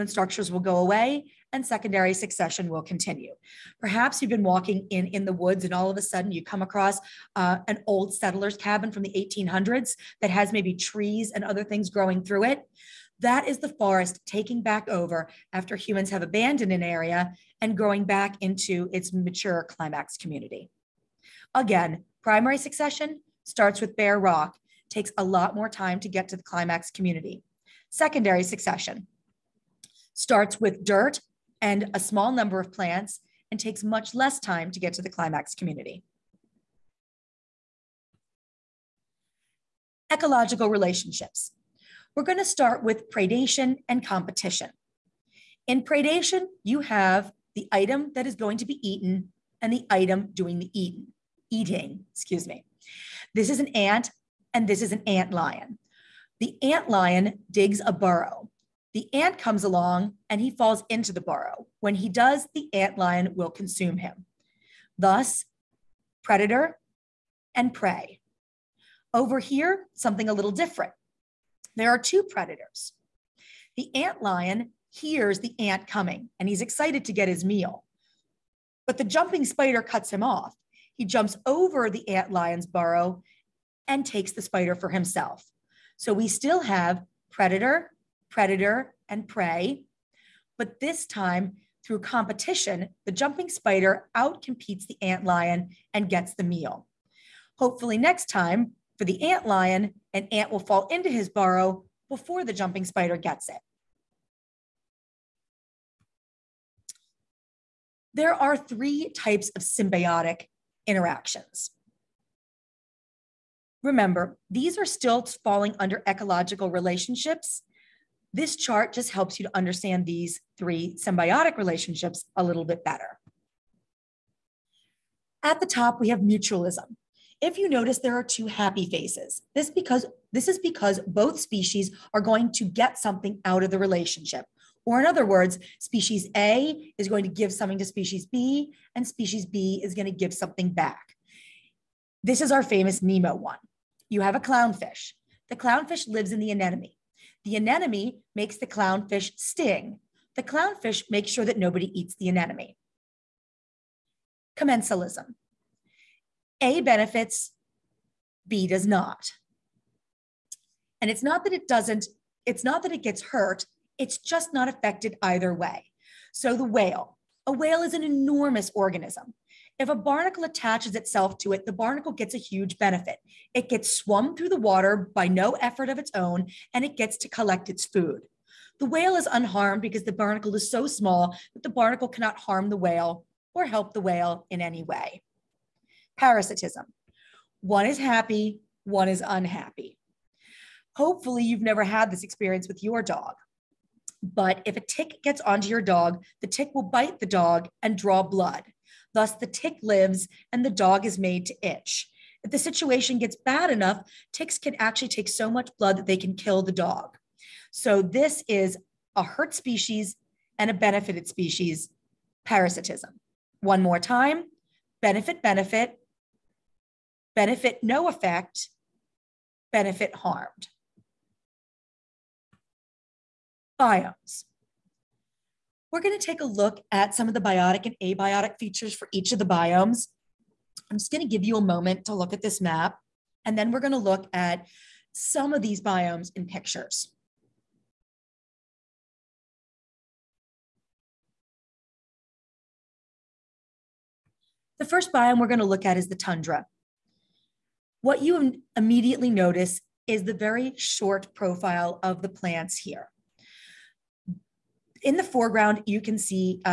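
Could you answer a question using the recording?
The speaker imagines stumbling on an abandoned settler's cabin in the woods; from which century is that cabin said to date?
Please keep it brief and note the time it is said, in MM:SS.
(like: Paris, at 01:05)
1800s, at 00:09.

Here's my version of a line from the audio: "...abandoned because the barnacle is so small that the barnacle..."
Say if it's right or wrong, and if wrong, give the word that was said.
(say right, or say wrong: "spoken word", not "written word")
wrong: "unharmed", not "abandoned".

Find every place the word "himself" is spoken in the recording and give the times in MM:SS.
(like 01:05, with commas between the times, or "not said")
01:24.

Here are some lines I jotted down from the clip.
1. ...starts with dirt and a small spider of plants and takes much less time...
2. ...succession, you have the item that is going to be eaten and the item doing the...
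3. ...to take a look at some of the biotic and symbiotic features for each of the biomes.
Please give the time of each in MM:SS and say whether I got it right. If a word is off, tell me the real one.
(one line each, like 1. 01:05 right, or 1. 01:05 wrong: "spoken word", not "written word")
1. 00:30 wrong: "number", not "spider"
2. 00:45 wrong: "predation", not "succession"
3. 03:46 wrong: "abiotic", not "symbiotic".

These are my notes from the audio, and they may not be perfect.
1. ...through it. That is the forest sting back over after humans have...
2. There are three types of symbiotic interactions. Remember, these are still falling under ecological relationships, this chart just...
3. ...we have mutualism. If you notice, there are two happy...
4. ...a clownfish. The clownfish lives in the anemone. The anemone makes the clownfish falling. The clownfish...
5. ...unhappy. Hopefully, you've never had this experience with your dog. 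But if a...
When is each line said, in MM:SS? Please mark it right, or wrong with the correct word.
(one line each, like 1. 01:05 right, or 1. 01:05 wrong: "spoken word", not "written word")
1. 00:12 wrong: "taking", not "sting"
2. 01:48 right
3. 02:06 right
4. 02:24 wrong: "sting", not "falling"
5. 03:09 right.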